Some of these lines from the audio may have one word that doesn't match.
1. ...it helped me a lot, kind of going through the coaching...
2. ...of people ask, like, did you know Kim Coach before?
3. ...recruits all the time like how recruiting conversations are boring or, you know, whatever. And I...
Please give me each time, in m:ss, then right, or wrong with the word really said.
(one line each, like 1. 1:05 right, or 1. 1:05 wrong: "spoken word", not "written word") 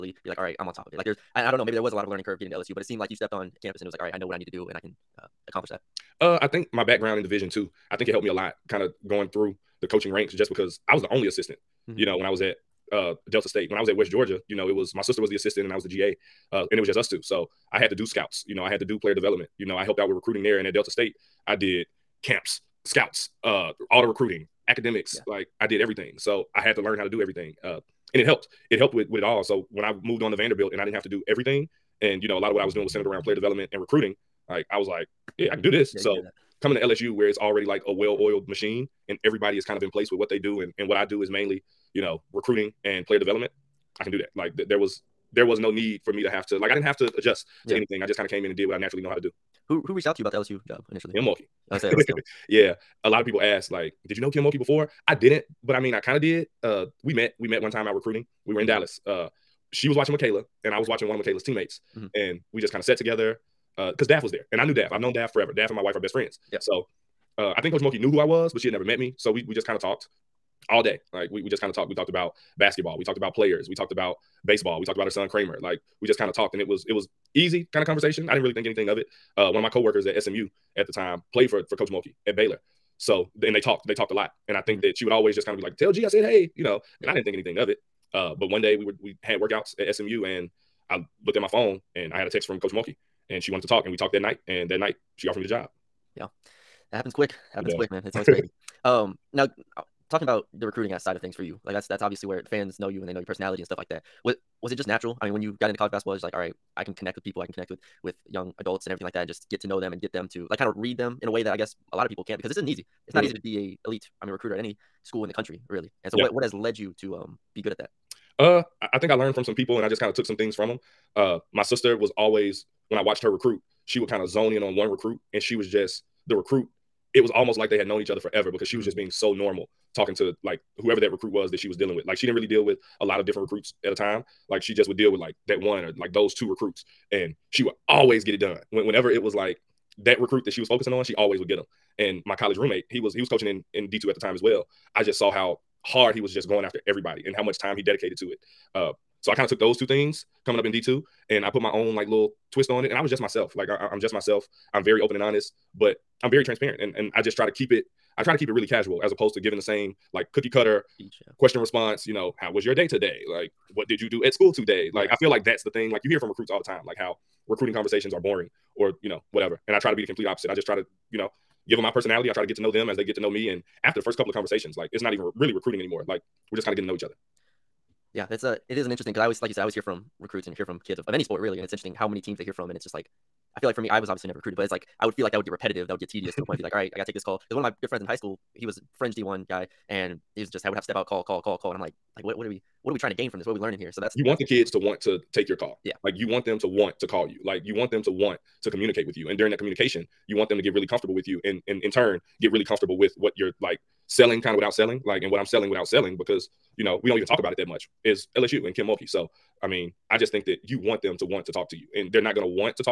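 1. 0:08 right
2. 0:53 wrong: "Mulkey", not "Coach"
3. 2:46 right.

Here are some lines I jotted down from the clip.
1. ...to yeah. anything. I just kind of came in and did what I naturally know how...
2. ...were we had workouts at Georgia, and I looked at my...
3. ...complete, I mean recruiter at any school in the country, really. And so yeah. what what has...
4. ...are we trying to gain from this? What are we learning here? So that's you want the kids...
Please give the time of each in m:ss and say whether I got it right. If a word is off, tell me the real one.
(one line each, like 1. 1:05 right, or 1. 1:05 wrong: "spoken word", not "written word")
1. 0:47 right
2. 1:28 wrong: "SMU", not "Georgia"
3. 1:53 wrong: "elite", not "complete"
4. 3:12 right.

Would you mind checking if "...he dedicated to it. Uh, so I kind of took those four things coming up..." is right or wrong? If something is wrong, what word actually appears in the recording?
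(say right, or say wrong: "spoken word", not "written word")
wrong: "two", not "four".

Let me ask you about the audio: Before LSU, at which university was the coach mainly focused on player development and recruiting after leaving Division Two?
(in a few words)
Vanderbilt.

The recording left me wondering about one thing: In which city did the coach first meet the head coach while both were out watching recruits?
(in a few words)
Dallas.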